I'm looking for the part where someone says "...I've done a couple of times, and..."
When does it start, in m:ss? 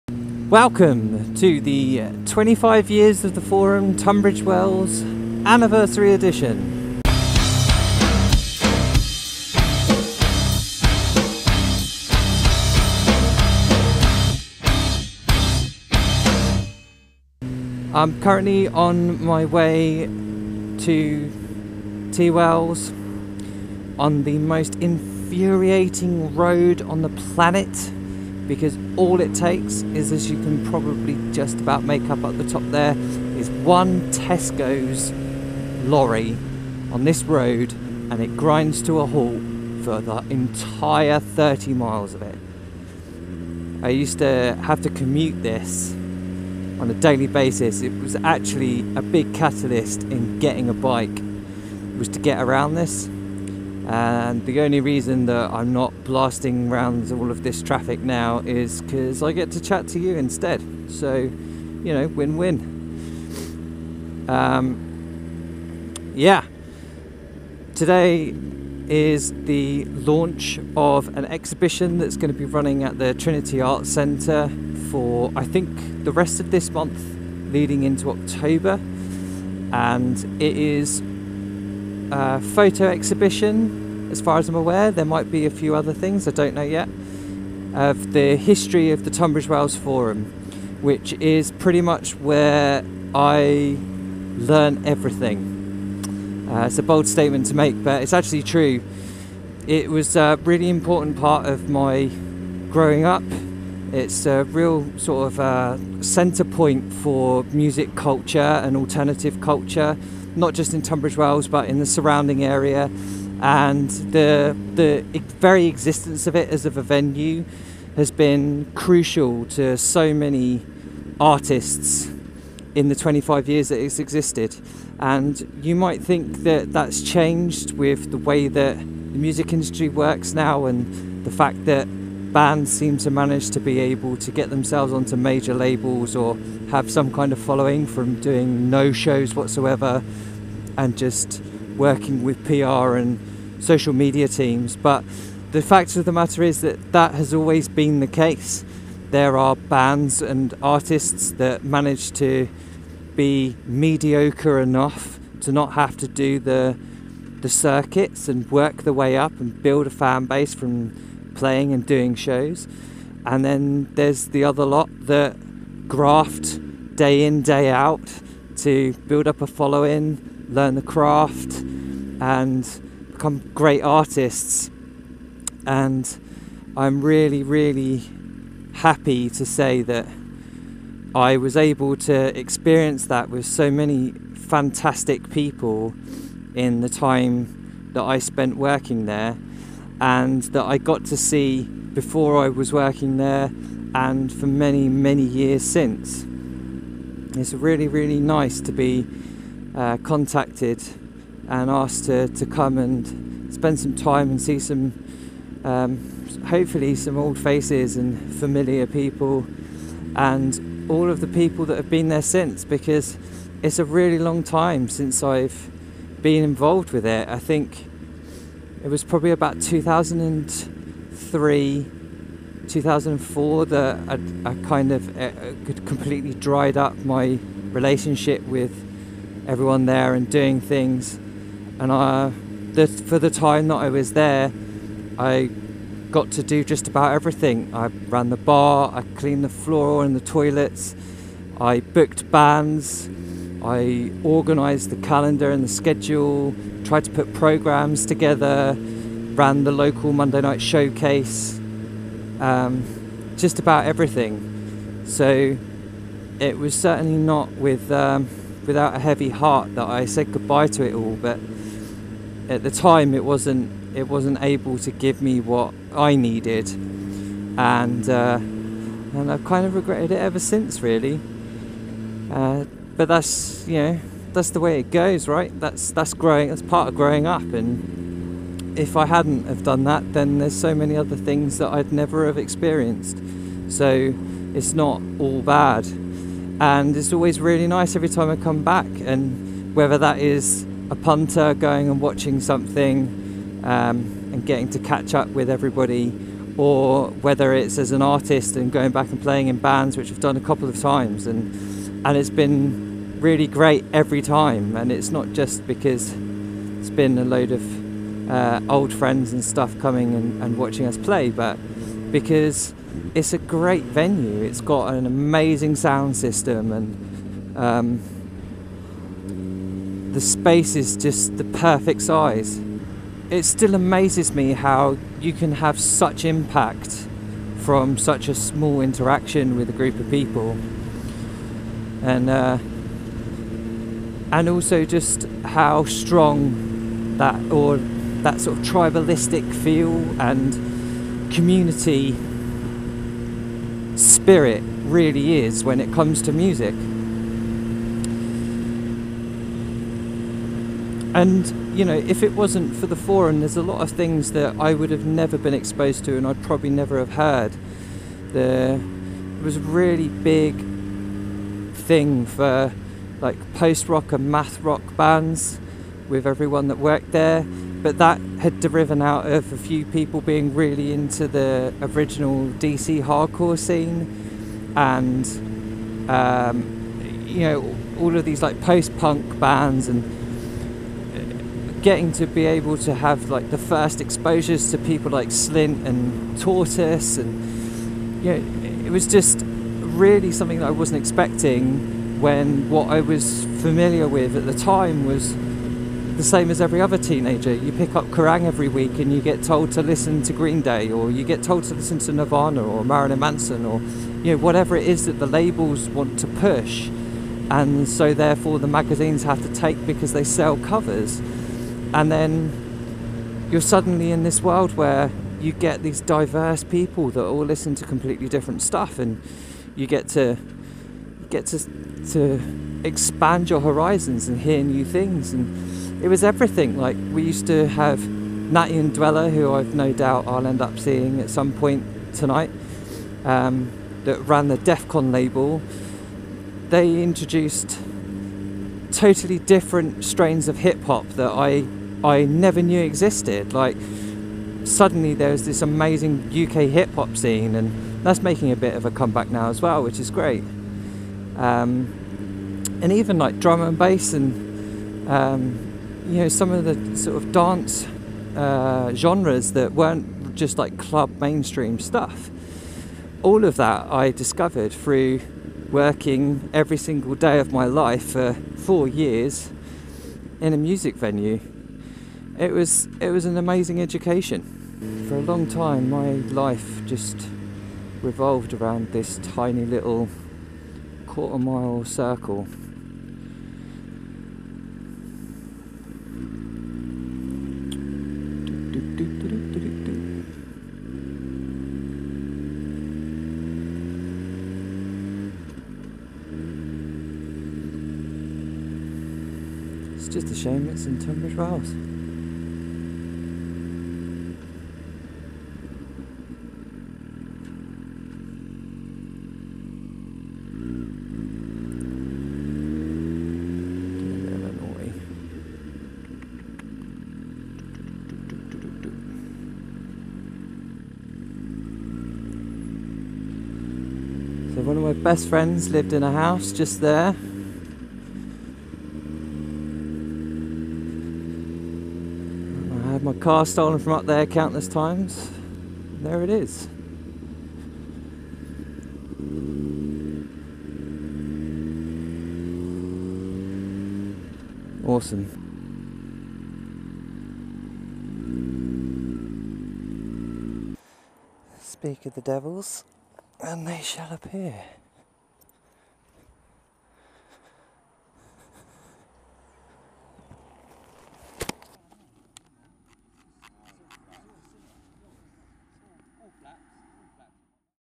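5:00.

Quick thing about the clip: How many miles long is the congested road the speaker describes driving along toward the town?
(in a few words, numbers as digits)
30.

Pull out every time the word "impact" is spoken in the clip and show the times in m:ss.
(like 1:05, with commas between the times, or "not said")
5:26.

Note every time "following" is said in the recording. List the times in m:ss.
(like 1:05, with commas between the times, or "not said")
2:17, 2:49.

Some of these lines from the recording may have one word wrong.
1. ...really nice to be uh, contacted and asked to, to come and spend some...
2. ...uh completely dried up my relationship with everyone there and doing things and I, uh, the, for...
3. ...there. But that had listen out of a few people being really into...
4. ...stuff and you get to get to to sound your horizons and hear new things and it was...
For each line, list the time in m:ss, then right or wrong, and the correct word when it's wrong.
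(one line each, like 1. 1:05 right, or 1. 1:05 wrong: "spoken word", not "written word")
1. 3:17 right
2. 3:45 right
3. 6:07 wrong: "driven", not "listen"
4. 6:58 wrong: "expand", not "sound".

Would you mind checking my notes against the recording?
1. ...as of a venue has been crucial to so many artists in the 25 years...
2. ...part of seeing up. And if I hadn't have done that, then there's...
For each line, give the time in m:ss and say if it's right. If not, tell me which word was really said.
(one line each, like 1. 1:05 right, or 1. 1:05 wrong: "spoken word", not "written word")
1. 1:56 right
2. 4:36 wrong: "growing", not "seeing".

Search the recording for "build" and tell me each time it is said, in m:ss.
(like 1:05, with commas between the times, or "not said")
2:39, 2:49.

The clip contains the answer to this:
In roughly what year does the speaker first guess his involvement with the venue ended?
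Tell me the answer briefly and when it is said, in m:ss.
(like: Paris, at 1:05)
2003, at 3:39.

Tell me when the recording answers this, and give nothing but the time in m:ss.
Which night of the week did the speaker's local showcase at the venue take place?
4:10.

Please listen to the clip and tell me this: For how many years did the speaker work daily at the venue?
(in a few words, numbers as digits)
4.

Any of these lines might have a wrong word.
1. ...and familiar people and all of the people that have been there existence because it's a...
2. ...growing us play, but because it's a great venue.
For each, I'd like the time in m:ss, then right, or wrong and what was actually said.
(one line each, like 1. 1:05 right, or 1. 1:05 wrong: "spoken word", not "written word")
1. 3:27 wrong: "since", not "existence"
2. 5:10 wrong: "watching", not "growing".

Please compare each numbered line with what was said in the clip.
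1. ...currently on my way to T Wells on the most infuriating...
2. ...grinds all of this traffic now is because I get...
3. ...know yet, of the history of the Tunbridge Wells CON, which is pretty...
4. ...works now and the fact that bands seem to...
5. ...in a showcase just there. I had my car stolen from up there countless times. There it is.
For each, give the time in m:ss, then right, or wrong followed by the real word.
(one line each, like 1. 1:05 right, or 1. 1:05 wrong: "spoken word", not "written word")
1. 0:18 right
2. 0:56 wrong: "rounds", not "grinds"
3. 1:26 wrong: "Forum", not "CON"
4. 2:09 right
5. 8:45 wrong: "house", not "showcase".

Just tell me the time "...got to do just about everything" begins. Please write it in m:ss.
3:56.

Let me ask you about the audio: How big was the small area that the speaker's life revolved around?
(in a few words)
quarter mile.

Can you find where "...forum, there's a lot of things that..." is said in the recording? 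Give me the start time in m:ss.
5:52.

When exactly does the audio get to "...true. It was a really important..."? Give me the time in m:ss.
1:38.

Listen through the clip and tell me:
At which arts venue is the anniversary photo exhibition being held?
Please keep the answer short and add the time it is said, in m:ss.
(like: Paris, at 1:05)
Trinity Arts Centre, at 1:13.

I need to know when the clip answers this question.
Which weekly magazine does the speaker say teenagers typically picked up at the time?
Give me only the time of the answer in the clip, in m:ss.
6:38.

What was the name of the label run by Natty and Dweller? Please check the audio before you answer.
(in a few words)
DEF CON.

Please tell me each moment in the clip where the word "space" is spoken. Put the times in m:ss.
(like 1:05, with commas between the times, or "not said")
5:20.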